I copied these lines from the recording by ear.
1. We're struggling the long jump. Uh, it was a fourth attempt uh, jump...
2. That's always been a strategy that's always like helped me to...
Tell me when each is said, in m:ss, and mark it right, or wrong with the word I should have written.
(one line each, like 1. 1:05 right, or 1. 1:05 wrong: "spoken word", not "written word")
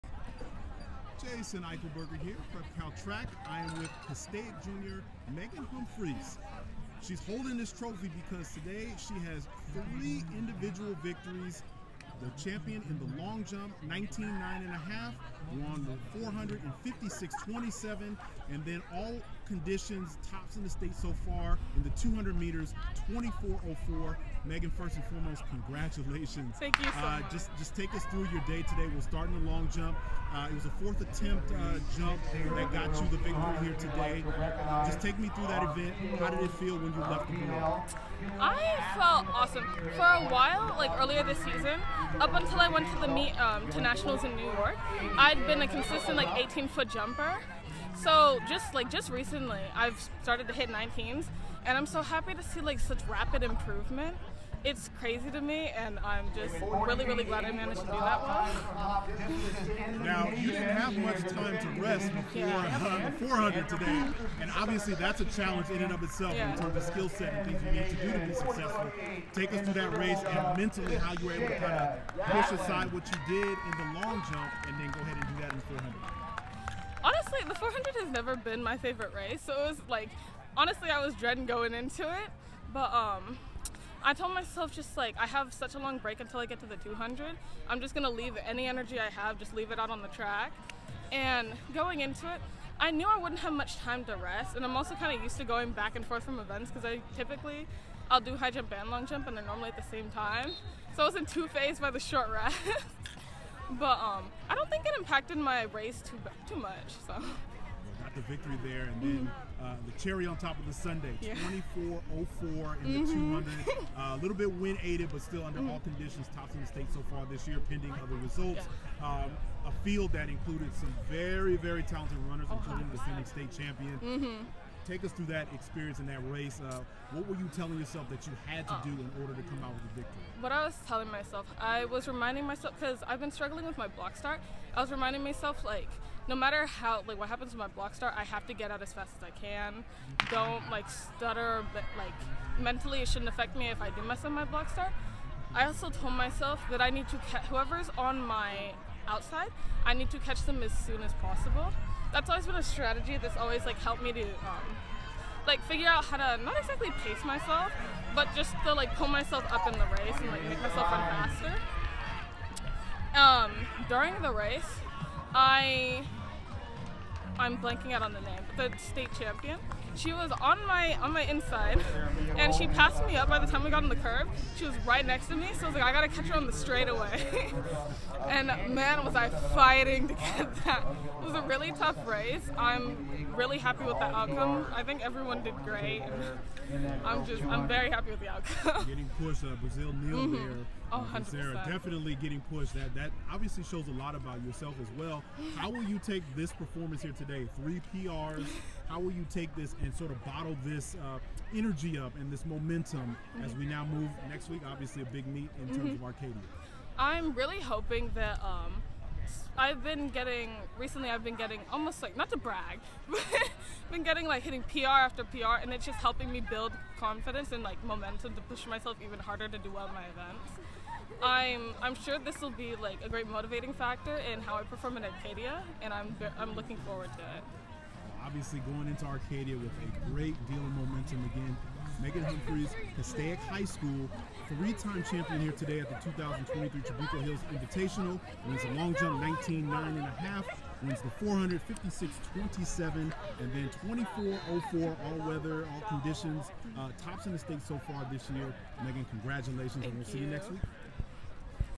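1. 0:28 wrong: "starting", not "struggling"
2. 2:32 right.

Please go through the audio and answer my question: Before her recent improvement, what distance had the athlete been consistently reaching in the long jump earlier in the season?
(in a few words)
18 feet.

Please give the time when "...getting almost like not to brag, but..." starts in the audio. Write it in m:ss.
3:31.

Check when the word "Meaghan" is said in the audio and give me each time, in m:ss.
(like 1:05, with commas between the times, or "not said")
0:05, 0:24, 3:52, 4:08.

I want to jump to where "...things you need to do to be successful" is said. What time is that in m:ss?
1:07.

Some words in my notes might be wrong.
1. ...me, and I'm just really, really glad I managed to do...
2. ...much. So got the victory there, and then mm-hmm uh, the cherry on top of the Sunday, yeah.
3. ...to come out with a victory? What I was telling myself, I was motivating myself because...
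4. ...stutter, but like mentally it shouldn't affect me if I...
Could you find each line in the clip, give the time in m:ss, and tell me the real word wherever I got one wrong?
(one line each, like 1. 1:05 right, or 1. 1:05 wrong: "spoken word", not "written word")
1. 0:55 right
2. 1:46 right
3. 2:09 wrong: "reminding", not "motivating"
4. 2:20 right.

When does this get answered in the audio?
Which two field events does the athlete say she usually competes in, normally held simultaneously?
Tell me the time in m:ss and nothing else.
1:38.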